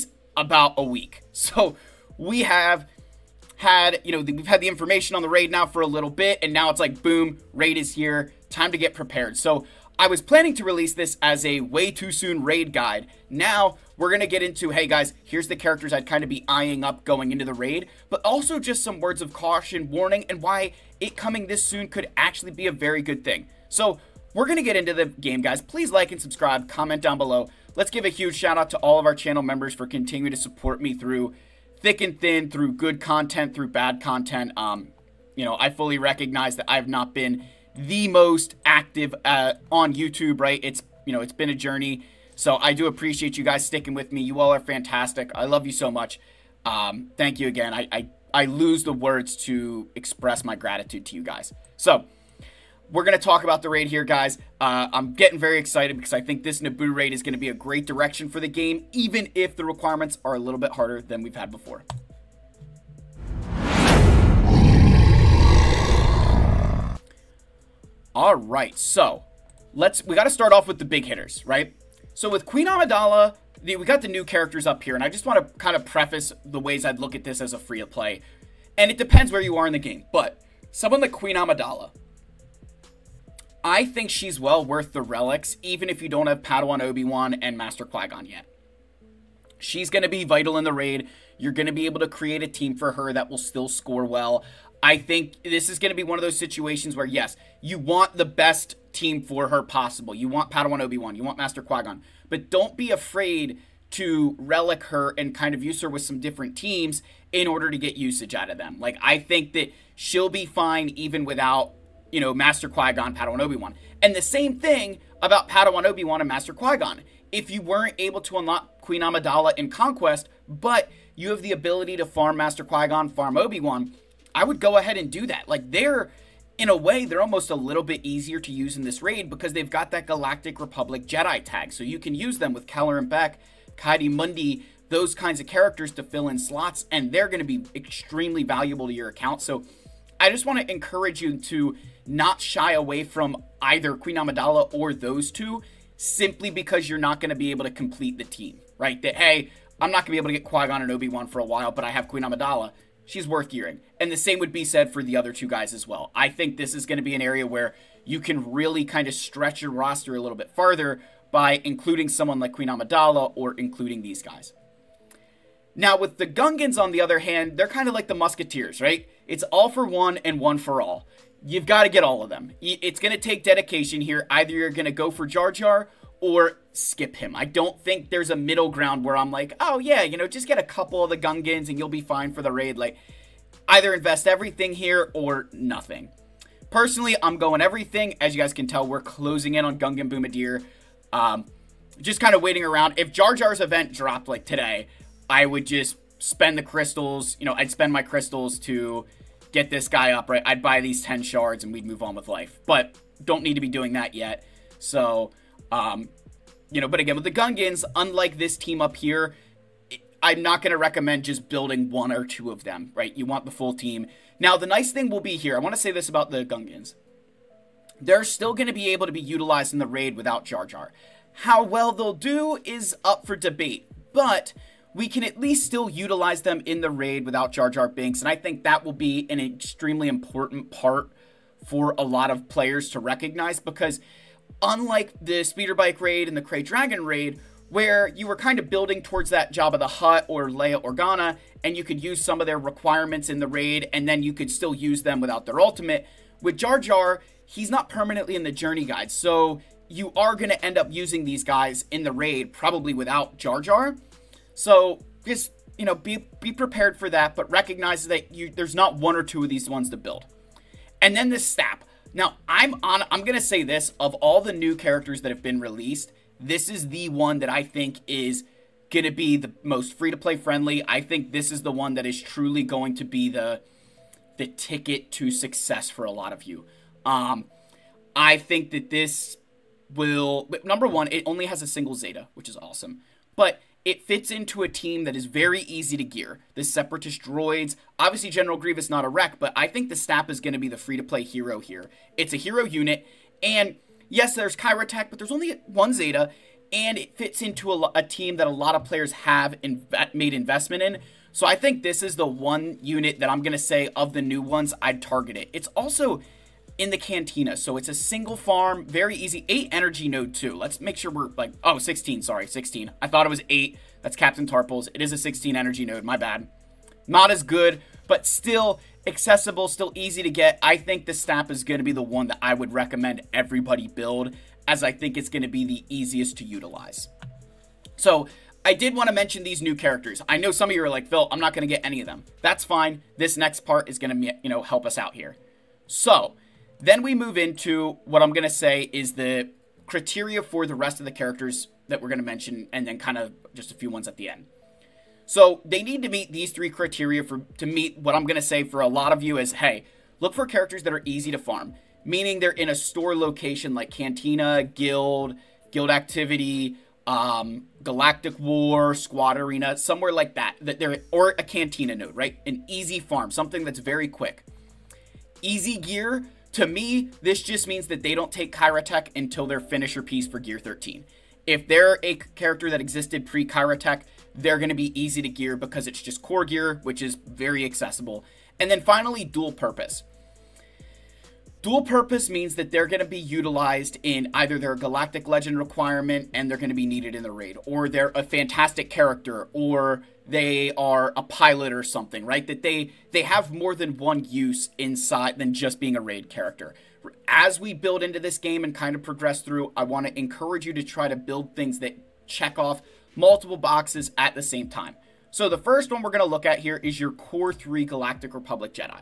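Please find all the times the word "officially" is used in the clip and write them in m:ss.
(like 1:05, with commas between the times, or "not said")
not said.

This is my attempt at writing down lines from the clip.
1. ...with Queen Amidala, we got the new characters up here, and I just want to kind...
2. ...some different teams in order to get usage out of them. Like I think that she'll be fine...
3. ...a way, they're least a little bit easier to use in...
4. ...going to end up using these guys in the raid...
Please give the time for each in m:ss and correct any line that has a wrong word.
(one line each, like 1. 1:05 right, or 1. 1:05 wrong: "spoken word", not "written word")
1. 1:12 right
2. 1:46 right
3. 2:06 wrong: "almost", not "least"
4. 4:10 right.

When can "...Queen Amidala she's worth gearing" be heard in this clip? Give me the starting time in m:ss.
2:32.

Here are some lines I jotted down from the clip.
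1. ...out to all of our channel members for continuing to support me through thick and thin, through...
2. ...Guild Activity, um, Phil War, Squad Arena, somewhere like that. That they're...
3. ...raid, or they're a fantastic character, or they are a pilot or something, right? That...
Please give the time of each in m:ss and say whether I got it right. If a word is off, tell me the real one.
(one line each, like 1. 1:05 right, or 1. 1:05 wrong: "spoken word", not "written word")
1. 0:28 right
2. 5:55 wrong: "Galactic", not "Phil"
3. 6:27 right.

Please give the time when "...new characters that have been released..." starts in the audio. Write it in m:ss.
4:24.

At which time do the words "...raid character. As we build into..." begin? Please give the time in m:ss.
6:36.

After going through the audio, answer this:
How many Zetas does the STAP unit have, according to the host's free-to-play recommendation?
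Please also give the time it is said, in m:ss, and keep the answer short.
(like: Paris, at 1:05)
1, at 4:41.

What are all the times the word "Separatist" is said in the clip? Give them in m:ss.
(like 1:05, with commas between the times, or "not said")
4:46.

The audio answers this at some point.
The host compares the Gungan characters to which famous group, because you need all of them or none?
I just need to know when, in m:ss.
2:48.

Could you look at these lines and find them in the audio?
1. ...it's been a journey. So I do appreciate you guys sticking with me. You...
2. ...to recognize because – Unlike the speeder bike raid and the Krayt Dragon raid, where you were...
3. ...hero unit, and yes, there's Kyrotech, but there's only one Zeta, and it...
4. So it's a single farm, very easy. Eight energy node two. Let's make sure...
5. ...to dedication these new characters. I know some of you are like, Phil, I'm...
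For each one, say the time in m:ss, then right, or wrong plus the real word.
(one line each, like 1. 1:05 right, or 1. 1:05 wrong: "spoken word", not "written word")
1. 0:41 right
2. 3:52 right
3. 4:52 right
4. 5:07 right
5. 5:29 wrong: "mention", not "dedication".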